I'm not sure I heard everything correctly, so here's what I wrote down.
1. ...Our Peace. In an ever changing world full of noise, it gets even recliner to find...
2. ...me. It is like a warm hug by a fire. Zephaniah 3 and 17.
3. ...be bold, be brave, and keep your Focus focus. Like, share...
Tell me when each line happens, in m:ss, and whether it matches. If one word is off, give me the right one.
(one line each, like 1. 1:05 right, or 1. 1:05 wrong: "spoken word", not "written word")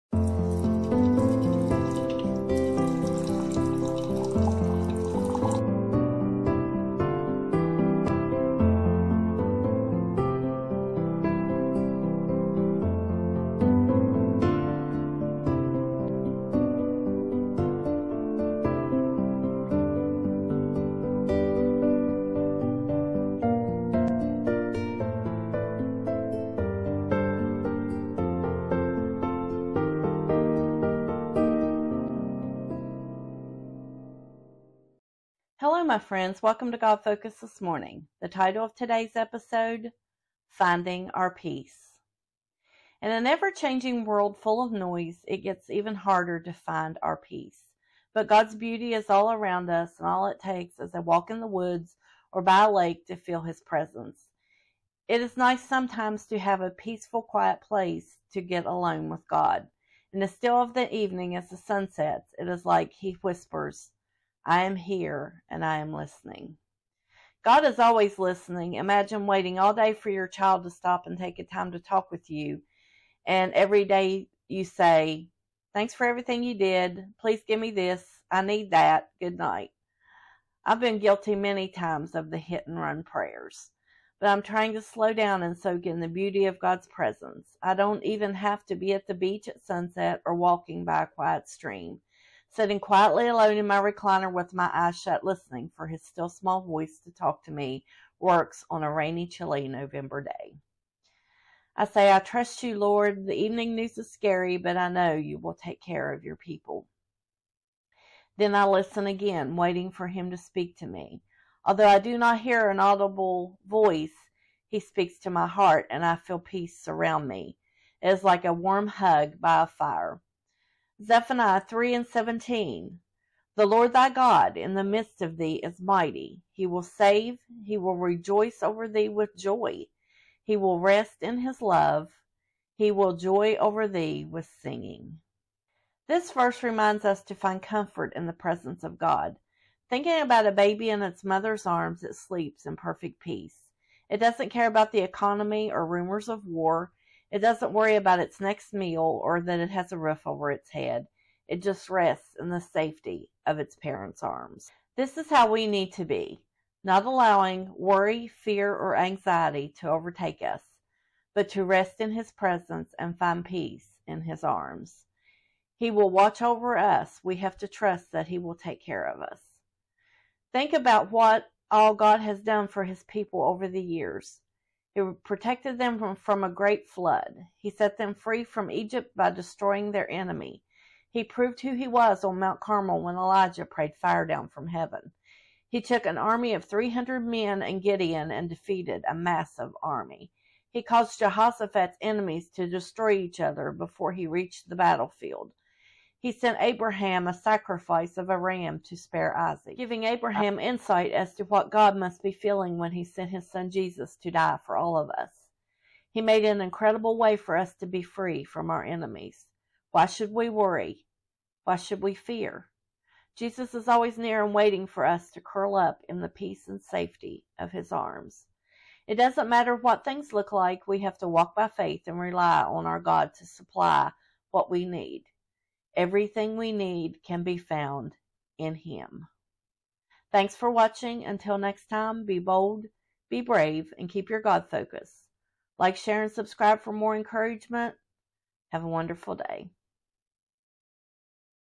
1. 0:41 wrong: "harder", not "recliner"
2. 1:57 right
3. 3:52 wrong: "God", not "Focus".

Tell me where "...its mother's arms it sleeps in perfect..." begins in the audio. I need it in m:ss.
2:21.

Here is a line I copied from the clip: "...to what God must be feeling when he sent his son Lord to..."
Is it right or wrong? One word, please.
wrong.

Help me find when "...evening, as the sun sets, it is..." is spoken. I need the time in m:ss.
1:00.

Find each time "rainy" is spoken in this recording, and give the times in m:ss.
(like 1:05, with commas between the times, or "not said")
1:38.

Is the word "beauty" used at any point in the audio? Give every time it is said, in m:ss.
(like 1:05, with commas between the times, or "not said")
0:48, 1:26.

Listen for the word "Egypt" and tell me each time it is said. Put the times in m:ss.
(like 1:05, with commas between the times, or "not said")
2:58.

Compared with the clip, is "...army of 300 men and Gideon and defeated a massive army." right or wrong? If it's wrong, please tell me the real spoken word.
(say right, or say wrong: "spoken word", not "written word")
right.